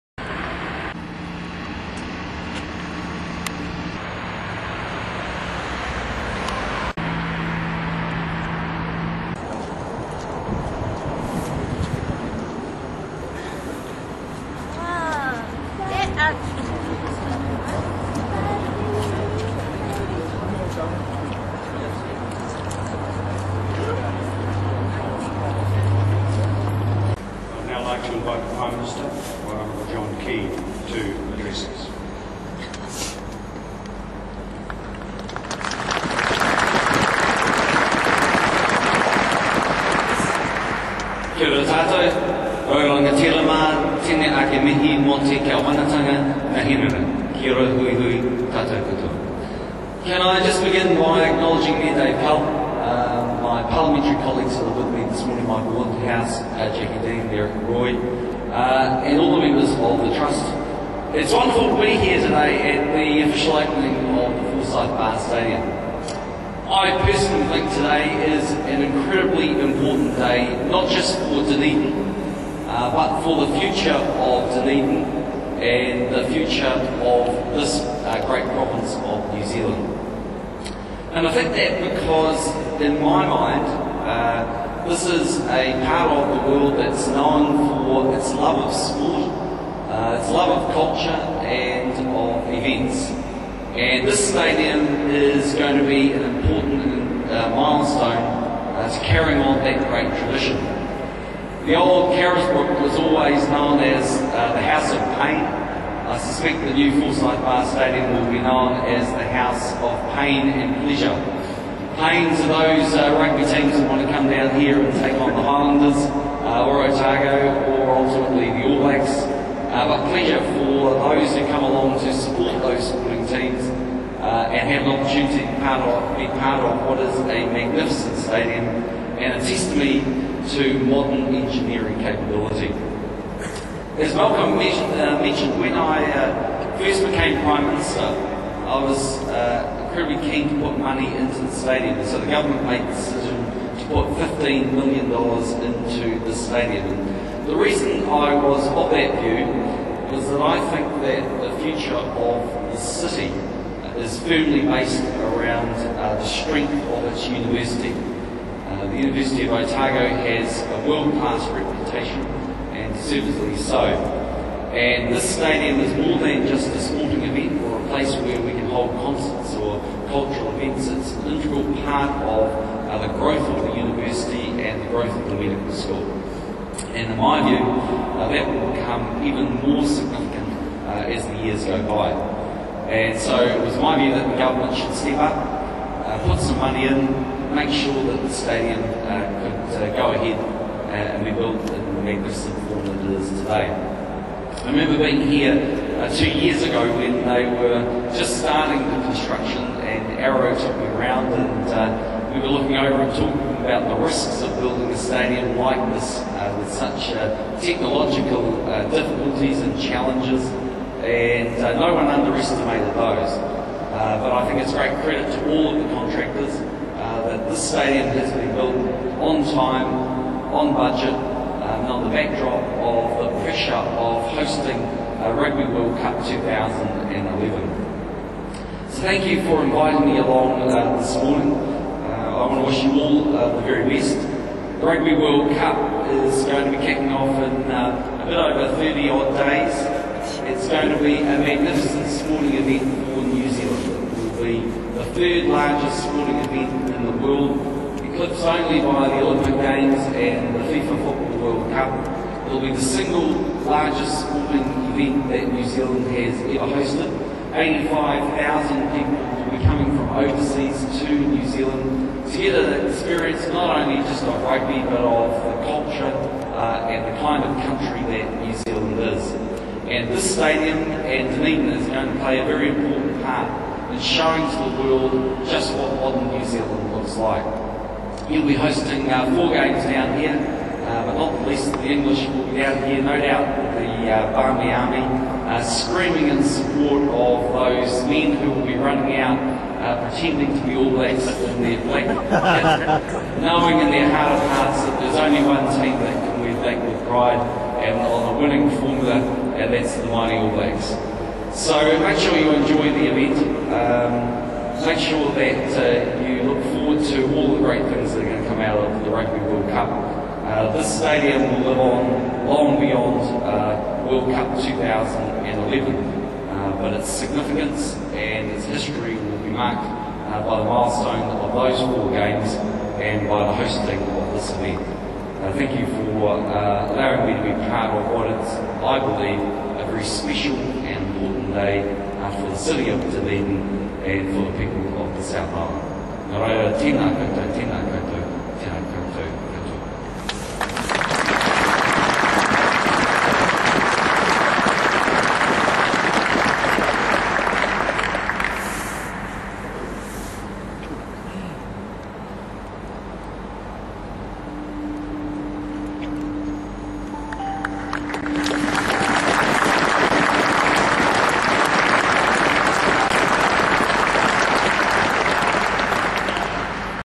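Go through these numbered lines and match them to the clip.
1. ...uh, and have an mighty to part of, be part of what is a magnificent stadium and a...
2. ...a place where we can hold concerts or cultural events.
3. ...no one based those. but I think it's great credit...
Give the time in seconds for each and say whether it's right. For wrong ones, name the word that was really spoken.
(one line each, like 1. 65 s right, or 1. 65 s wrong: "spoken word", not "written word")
1. 124 s wrong: "opportunity", not "mighty"
2. 167 s right
3. 211 s wrong: "underestimated", not "based".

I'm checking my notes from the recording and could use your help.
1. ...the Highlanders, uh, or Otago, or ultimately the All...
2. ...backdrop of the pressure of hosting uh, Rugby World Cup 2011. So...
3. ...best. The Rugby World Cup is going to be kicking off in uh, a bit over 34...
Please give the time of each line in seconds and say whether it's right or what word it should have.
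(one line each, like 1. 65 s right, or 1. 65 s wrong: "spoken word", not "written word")
1. 115 s right
2. 222 s right
3. 233 s wrong: "30", not "34".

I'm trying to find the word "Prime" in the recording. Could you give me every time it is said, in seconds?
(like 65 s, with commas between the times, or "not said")
28 s, 137 s.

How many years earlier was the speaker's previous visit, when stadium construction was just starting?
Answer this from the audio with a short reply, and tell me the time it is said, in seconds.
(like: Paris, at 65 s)
2, at 196 s.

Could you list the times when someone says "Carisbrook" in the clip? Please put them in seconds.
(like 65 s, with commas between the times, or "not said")
102 s.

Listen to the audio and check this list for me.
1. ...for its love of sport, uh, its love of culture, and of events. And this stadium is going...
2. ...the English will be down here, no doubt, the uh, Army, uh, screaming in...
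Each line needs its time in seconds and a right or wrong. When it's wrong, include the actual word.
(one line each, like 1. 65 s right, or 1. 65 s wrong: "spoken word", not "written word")
1. 87 s right
2. 281 s right.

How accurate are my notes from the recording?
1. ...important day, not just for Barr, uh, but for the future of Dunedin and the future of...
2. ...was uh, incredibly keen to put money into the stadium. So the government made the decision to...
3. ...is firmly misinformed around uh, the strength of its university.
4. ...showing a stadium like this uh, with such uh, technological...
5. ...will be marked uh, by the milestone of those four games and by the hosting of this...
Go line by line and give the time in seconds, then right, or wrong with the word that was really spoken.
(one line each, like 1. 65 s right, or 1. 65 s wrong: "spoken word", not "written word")
1. 69 s wrong: "Dunedin", not "Barr"
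2. 138 s right
3. 153 s wrong: "based", not "misinformed"
4. 204 s wrong: "building", not "showing"
5. 319 s right.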